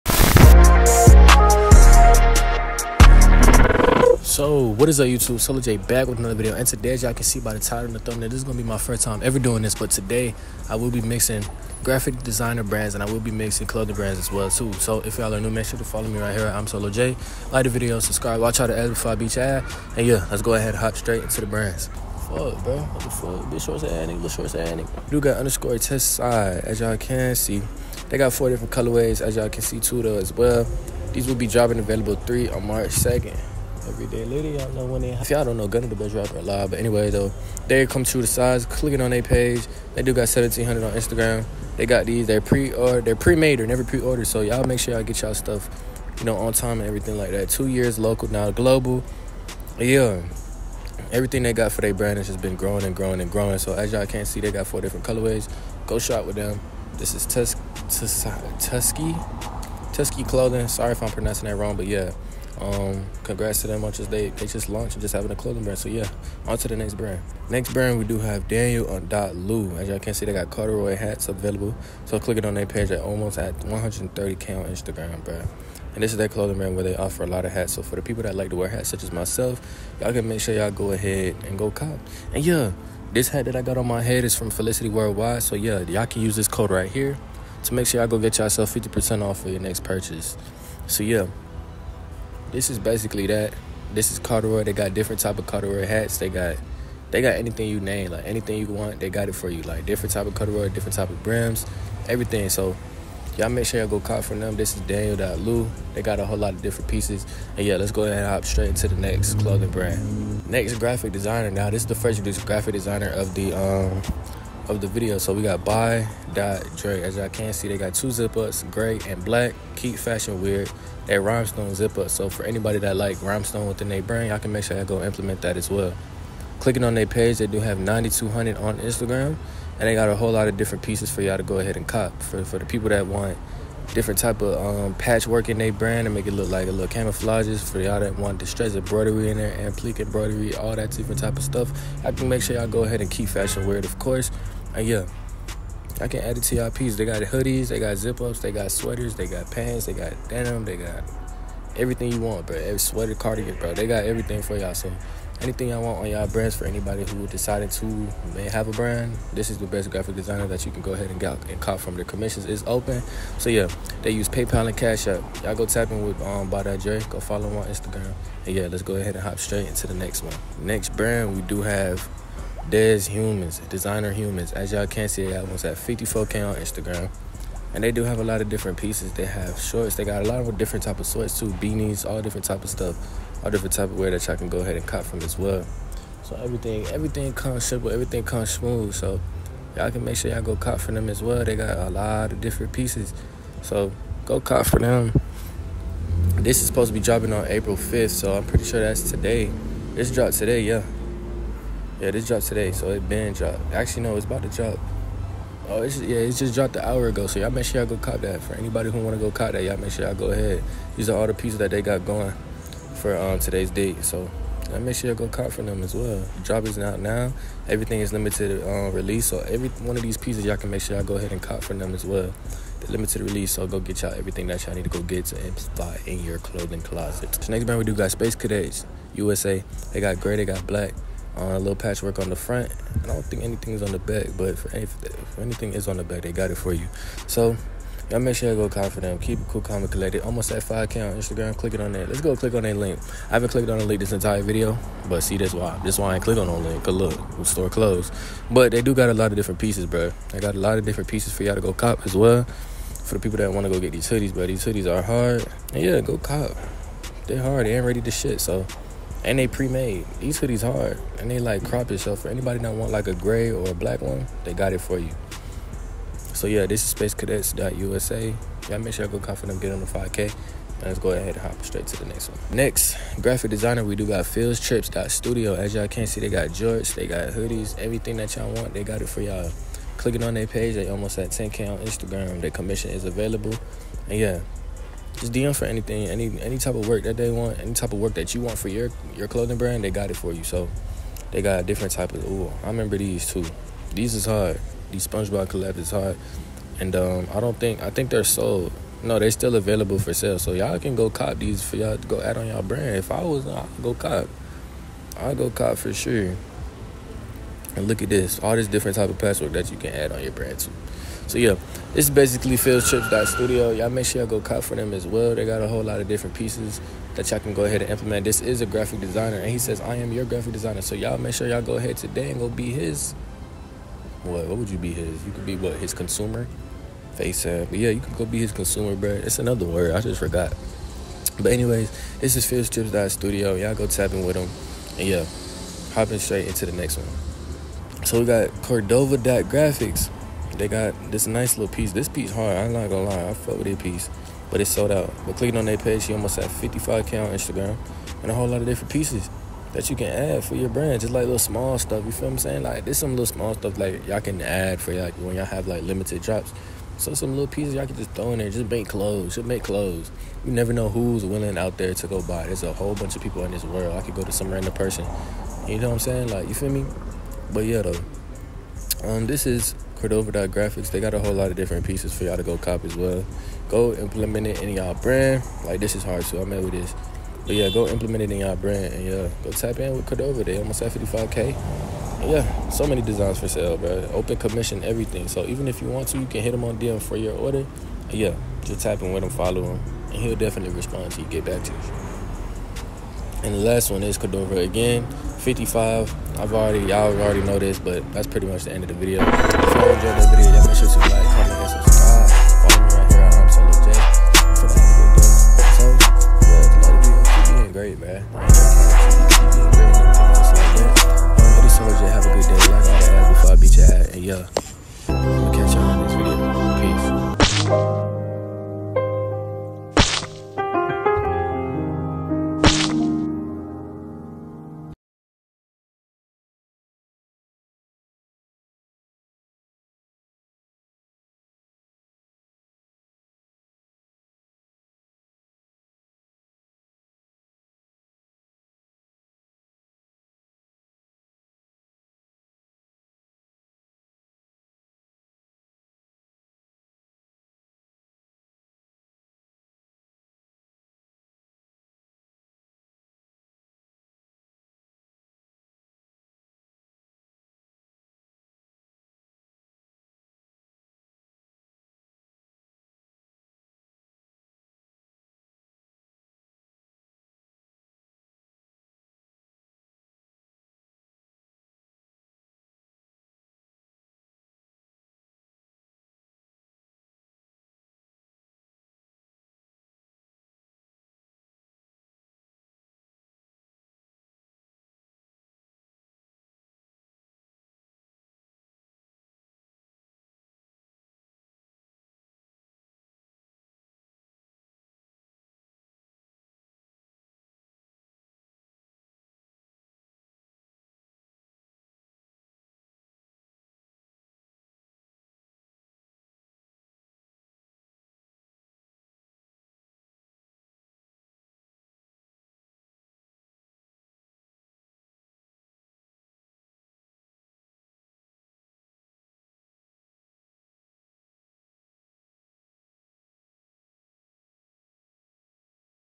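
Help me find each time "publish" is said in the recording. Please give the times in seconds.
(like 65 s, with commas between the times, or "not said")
not said.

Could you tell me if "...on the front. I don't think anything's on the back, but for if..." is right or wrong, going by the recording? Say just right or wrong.
right.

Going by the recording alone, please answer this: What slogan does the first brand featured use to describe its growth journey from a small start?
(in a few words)
Two years local now global.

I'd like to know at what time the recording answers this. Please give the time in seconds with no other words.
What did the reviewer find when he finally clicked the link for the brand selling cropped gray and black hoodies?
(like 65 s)
247 s.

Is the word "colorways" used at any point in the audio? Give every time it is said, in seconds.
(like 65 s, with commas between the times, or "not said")
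28 s, 55 s.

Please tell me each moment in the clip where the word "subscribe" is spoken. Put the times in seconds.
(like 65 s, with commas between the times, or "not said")
17 s.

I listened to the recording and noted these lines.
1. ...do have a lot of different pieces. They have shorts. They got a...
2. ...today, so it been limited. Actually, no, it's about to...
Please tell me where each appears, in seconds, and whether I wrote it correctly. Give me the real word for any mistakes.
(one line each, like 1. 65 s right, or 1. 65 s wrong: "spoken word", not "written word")
1. 177 s right
2. 202 s wrong: "dropped", not "limited".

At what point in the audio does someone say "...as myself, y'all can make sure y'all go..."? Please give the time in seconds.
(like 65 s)
79 s.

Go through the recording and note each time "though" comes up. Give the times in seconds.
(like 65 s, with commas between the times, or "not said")
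30 s, 37 s, 367 s.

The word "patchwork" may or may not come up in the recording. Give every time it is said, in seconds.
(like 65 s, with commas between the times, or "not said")
134 s, 231 s.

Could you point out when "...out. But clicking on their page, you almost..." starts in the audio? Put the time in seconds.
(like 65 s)
344 s.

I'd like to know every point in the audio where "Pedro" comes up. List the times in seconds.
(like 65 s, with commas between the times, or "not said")
not said.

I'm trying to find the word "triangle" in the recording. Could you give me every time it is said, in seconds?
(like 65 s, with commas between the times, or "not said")
not said.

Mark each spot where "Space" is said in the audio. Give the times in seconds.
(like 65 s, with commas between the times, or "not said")
228 s, 266 s.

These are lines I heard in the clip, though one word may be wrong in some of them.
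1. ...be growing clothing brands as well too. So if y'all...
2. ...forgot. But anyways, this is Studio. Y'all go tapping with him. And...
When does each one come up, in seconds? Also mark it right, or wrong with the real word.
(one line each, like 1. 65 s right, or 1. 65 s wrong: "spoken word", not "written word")
1. 13 s wrong: "mixing", not "growing"
2. 330 s right.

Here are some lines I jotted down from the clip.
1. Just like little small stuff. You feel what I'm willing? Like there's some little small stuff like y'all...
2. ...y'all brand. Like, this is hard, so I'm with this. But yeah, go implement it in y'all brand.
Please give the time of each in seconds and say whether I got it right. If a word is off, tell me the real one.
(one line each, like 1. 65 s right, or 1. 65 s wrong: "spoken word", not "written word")
1. 351 s wrong: "saying", not "willing"
2. 374 s right.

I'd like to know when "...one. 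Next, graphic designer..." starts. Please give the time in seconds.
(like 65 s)
272 s.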